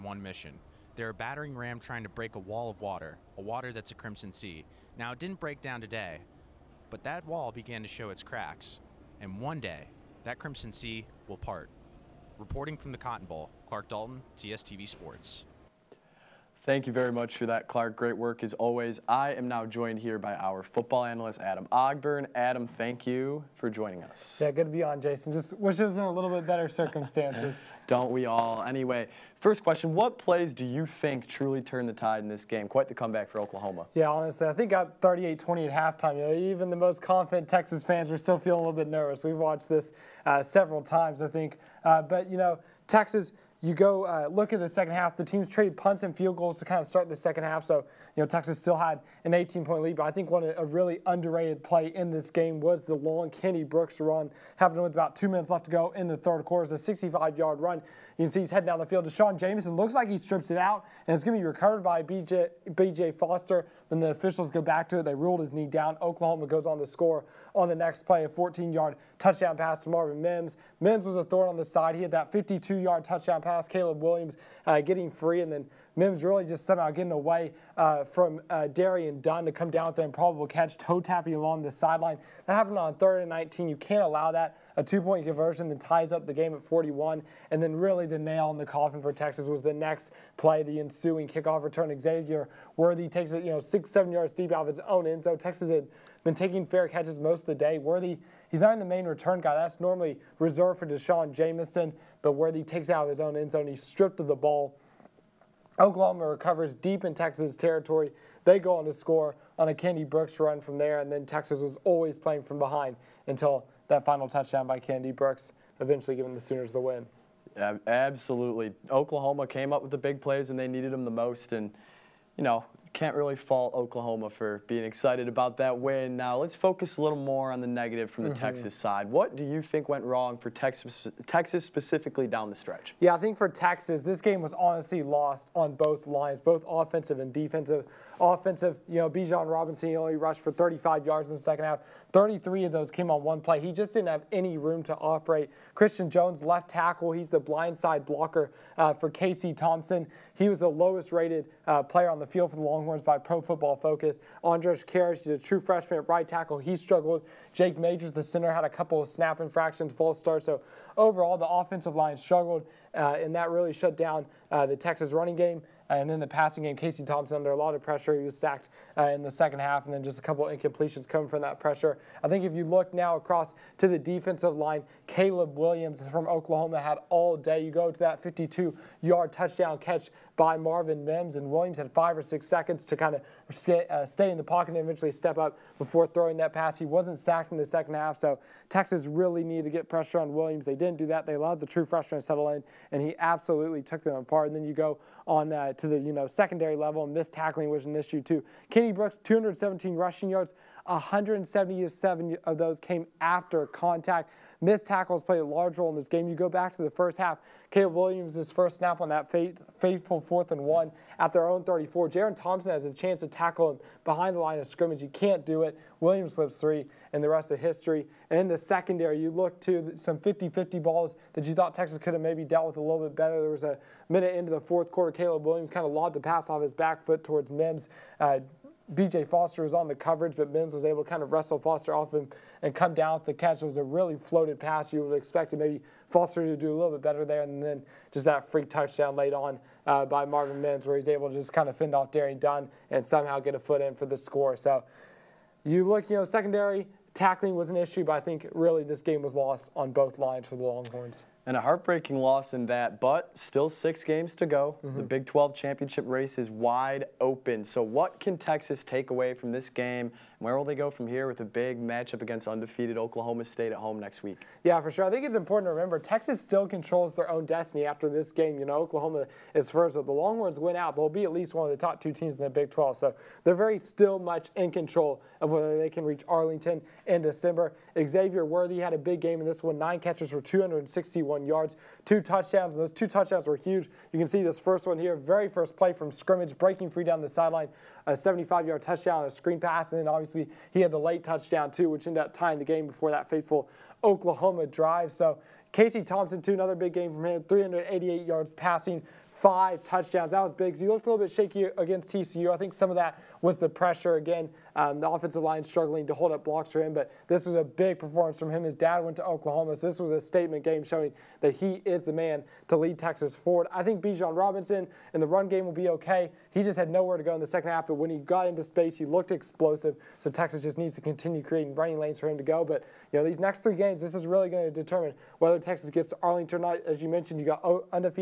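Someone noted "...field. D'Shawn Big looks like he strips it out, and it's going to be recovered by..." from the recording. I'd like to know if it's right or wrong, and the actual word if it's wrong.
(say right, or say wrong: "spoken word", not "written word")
wrong: "Jamison", not "Big".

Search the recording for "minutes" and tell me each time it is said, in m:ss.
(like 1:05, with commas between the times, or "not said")
0:55, 3:44.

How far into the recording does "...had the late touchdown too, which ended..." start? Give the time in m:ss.
4:50.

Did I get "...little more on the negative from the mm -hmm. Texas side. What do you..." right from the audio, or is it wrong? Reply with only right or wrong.
right.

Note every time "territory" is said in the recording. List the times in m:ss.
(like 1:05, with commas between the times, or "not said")
1:47.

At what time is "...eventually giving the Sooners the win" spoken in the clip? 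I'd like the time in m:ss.
1:55.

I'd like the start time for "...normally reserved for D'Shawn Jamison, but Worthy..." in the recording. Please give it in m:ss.
1:39.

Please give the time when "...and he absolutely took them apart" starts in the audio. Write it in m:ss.
3:12.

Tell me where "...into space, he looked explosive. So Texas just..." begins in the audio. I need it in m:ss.
5:18.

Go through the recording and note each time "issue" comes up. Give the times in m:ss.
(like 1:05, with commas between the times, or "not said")
3:17, 4:07.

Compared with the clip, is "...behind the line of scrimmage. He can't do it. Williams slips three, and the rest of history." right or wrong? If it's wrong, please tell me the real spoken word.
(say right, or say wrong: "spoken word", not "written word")
right.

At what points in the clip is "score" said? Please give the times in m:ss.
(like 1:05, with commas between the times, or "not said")
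1:06, 1:48, 4:04.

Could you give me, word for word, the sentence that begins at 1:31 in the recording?
Xavier Worthy takes it, you know, six, seven yards deep out of his own end.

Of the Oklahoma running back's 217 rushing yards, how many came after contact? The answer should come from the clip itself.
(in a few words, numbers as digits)
177.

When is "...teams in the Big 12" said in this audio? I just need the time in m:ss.
4:32.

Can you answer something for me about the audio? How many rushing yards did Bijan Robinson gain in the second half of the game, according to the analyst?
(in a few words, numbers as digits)
35.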